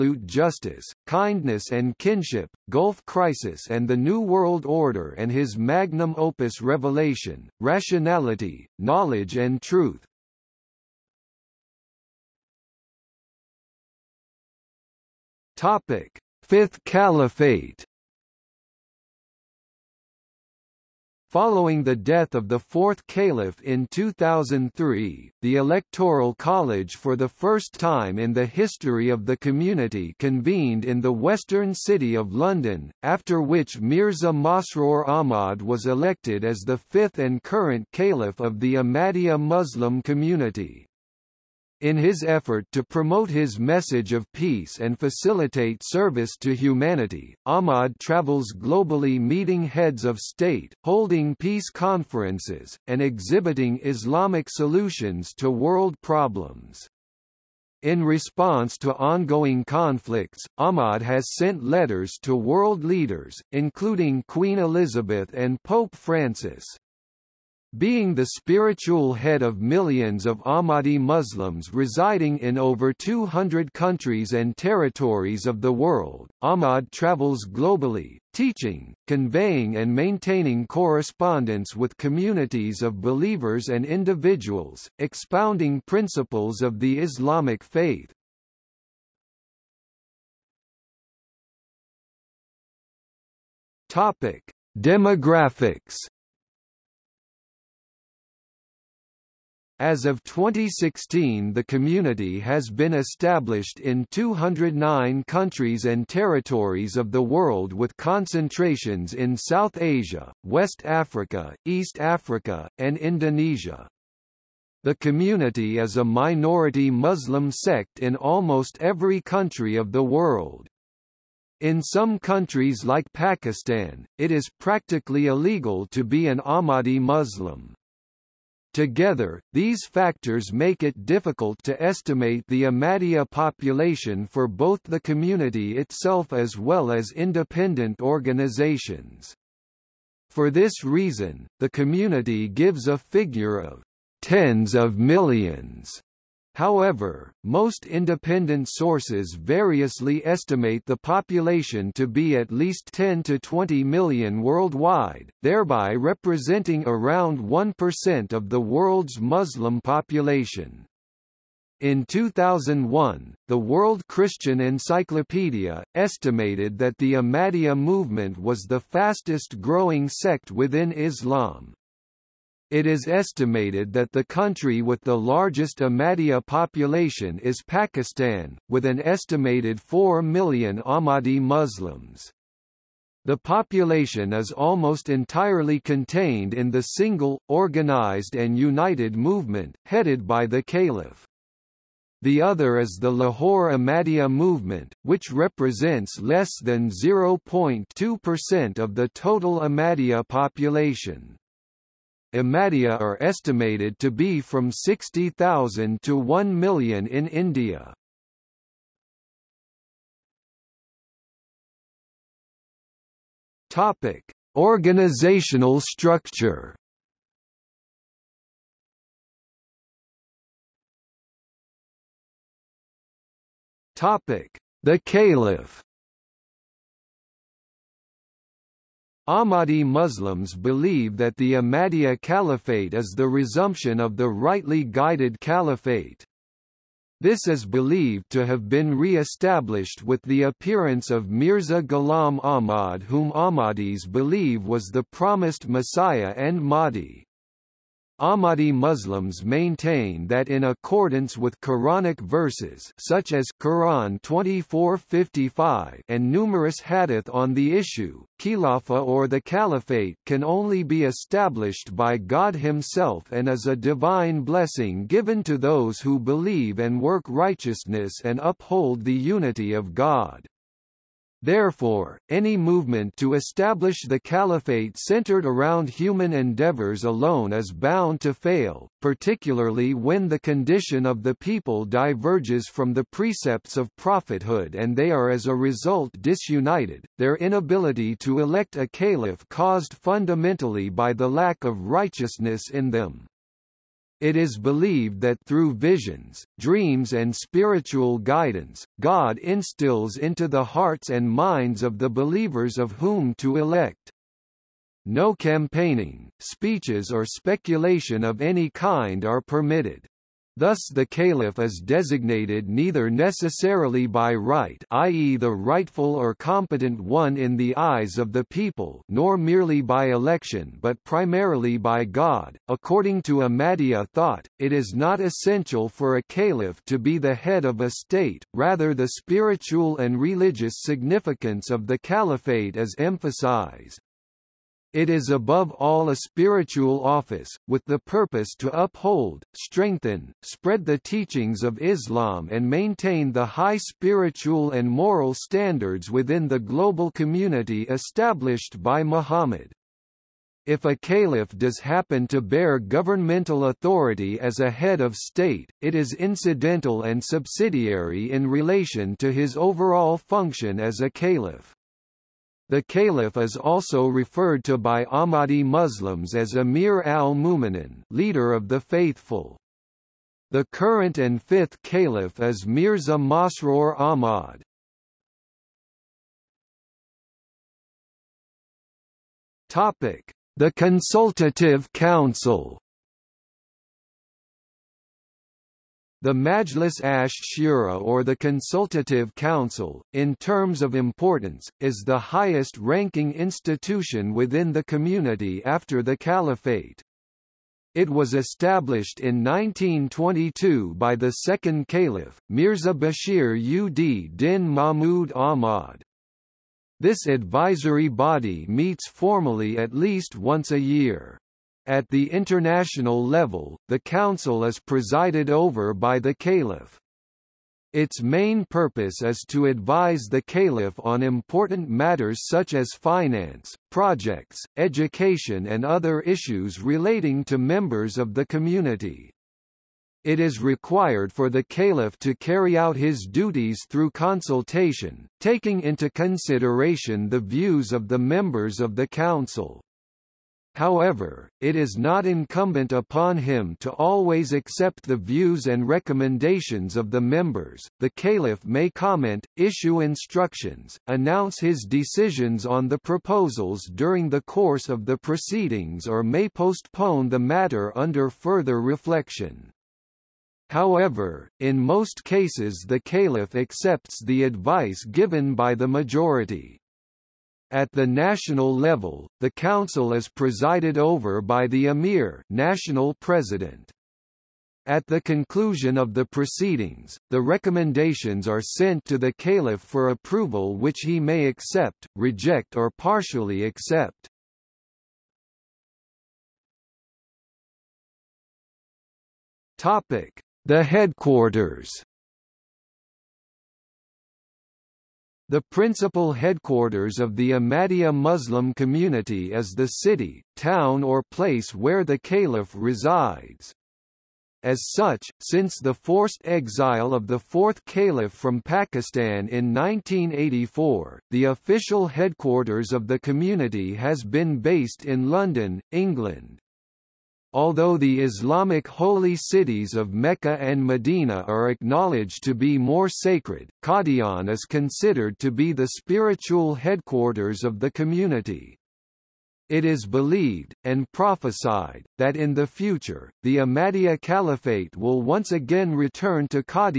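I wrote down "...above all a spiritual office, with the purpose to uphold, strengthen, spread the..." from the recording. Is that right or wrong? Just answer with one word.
right.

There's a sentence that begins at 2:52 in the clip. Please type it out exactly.
It is estimated that the country with the largest Ahmadiyya population is Pakistan, with an estimated 4 million Ahmadi Muslims.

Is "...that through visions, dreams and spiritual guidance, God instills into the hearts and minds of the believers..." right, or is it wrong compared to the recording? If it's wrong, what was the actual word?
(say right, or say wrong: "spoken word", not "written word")
right.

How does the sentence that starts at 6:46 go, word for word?
This advisory body meets formally at least once a year.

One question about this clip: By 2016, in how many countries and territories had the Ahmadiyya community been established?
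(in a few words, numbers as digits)
209.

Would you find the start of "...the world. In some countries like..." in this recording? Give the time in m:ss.
1:59.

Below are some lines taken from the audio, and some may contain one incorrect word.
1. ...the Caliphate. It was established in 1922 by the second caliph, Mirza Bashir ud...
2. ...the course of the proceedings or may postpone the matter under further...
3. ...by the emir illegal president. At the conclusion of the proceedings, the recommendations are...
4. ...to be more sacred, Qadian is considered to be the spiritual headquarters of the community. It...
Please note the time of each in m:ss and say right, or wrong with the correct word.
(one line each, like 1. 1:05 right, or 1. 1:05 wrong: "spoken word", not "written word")
1. 6:36 right
2. 7:34 right
3. 7:51 wrong: "national", not "illegal"
4. 8:42 right.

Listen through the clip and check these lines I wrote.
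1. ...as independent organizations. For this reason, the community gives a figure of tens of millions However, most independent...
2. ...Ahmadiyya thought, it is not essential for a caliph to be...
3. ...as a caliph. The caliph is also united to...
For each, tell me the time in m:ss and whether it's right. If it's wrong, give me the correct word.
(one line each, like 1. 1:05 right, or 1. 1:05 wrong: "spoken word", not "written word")
1. 2:16 right
2. 5:23 right
3. 6:00 wrong: "referred", not "united".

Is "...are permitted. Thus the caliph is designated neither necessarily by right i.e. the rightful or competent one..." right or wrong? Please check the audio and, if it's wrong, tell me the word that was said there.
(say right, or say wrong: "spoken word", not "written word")
right.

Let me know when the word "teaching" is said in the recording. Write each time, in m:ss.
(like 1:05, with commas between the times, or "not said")
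1:18, 5:40.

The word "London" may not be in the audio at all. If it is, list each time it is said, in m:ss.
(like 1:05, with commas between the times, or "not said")
0:32, 8:35.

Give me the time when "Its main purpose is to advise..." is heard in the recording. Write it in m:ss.
6:57.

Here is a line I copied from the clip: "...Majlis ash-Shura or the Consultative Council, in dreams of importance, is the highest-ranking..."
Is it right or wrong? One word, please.
wrong.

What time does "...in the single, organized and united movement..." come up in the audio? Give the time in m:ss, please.
3:06.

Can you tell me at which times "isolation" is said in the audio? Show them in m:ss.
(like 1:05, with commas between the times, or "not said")
not said.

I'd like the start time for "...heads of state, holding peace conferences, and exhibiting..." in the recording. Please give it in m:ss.
0:49.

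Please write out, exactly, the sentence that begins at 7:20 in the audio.
However, it is not incumbent upon him to always accept the views and recommendations of the members.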